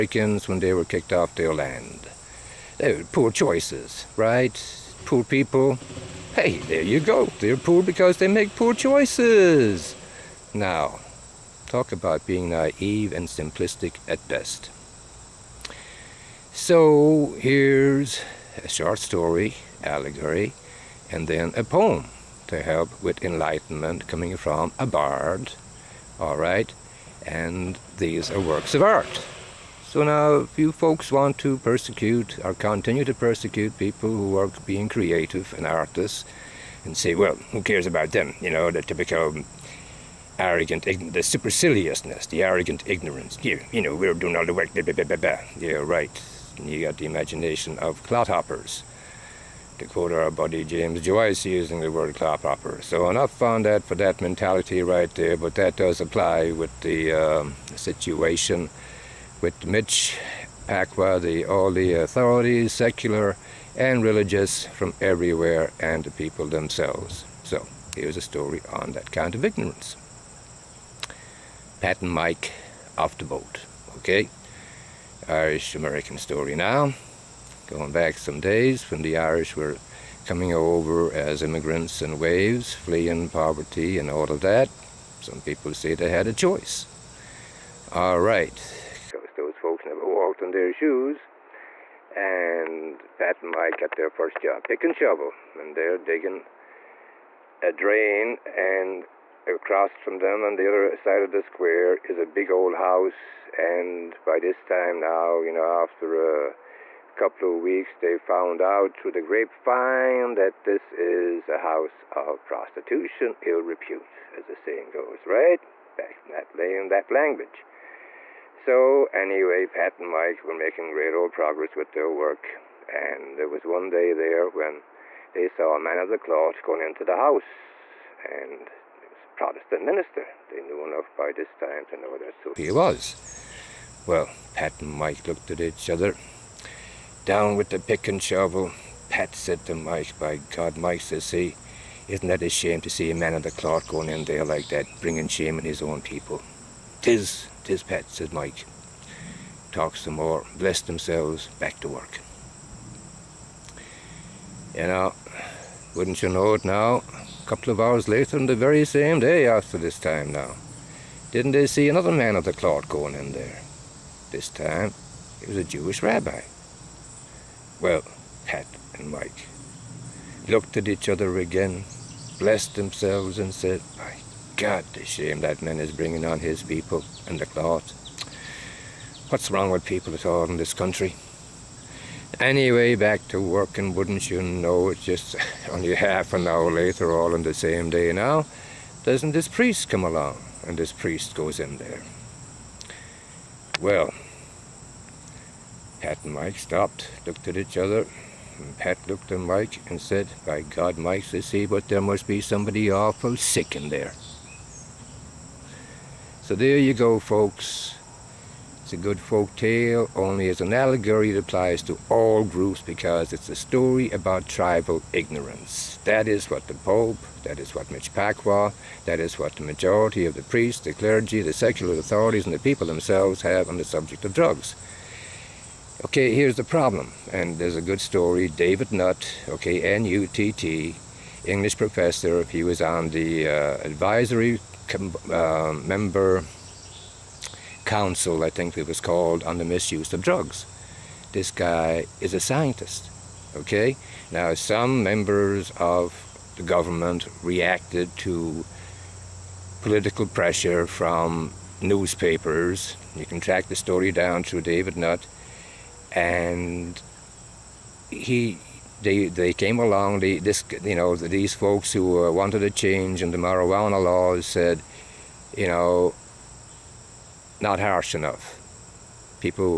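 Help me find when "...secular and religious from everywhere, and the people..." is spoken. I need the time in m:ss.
1:02.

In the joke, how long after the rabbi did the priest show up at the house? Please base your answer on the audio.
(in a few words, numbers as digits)
half an hour.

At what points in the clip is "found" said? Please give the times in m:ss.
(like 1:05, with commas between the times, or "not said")
0:53, 1:48.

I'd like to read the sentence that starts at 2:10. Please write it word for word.
They knew enough by this time to know that's who he was.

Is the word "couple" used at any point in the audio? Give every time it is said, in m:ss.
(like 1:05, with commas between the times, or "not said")
1:47, 2:37.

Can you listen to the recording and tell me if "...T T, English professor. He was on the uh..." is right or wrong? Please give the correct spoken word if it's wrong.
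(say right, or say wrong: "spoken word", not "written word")
right.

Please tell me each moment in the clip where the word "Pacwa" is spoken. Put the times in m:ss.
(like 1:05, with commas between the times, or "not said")
1:00, 3:38.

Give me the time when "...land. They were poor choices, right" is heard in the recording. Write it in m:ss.
0:01.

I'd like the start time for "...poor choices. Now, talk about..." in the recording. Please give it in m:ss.
0:08.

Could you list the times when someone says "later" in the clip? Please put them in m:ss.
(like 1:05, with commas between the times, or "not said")
2:38, 3:06.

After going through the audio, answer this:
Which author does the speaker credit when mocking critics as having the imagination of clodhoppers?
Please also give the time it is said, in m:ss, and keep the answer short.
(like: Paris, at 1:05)
James Joyce, at 0:50.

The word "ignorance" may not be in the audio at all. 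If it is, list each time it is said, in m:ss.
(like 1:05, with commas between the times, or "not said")
0:42, 1:09, 3:35.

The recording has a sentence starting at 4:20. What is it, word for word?
this you know these folks who uh, wanted a change in the marijuana laws said, you know, not harsh enough.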